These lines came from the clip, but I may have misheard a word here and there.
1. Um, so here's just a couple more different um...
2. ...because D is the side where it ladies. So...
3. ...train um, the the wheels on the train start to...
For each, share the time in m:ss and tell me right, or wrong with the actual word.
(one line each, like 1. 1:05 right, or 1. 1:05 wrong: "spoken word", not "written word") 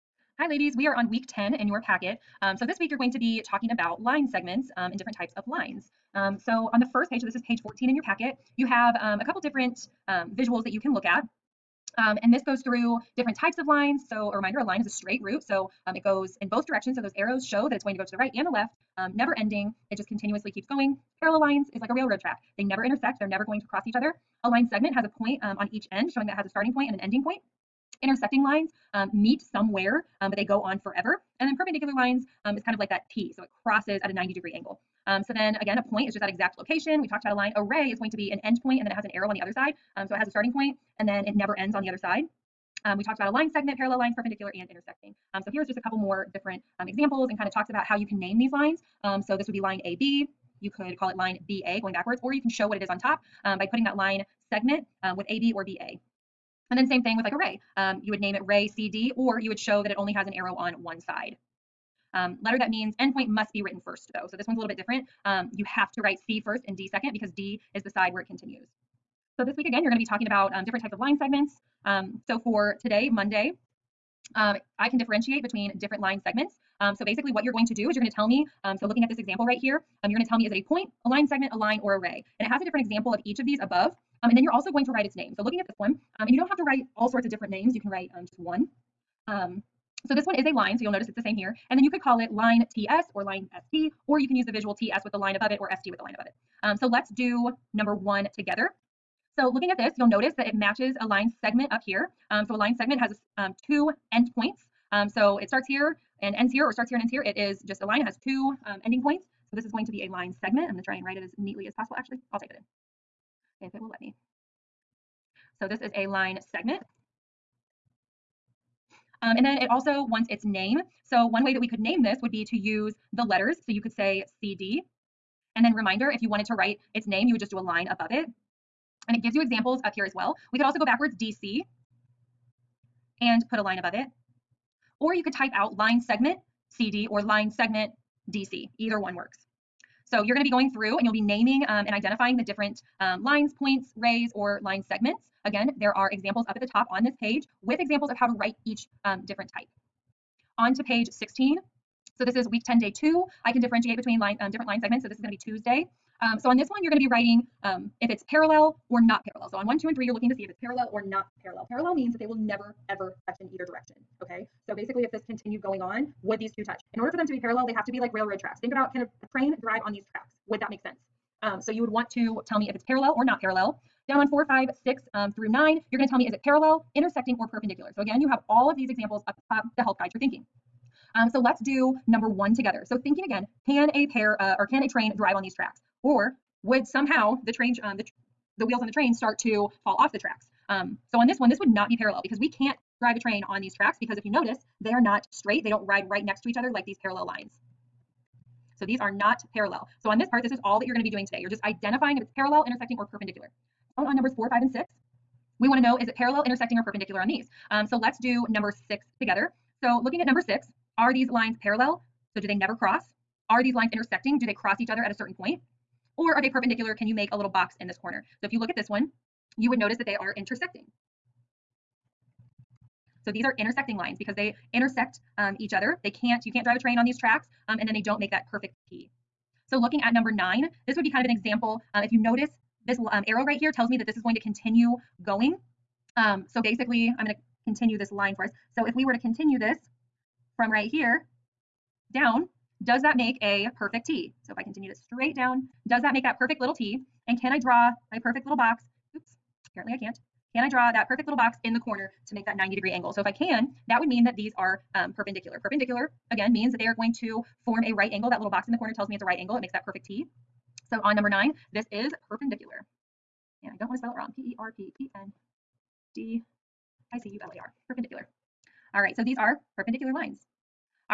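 1. 0:45 right
2. 1:07 wrong: "continues", not "ladies"
3. 3:07 right.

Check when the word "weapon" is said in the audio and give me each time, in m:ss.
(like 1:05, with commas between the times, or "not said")
not said.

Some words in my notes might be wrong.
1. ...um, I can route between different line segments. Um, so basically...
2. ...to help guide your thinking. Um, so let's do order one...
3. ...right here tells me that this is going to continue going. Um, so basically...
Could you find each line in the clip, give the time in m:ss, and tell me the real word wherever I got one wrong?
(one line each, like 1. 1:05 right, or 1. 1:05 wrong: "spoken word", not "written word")
1. 1:14 wrong: "differentiate", not "route"
2. 2:59 wrong: "number", not "order"
3. 3:53 right.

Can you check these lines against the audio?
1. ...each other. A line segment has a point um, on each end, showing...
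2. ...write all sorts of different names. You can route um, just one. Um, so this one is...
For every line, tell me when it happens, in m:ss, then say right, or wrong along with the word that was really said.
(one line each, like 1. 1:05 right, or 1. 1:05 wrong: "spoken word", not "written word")
1. 0:23 right
2. 1:26 wrong: "write", not "route".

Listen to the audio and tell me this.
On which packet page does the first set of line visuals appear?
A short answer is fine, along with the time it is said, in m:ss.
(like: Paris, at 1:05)
14, at 0:07.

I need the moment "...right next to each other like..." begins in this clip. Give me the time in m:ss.
3:16.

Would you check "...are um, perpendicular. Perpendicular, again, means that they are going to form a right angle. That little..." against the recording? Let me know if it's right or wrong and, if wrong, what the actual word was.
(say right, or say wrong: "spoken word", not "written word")
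right.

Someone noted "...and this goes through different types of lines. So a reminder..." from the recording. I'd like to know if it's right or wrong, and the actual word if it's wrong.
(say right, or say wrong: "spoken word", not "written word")
right.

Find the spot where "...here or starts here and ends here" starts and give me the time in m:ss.
1:46.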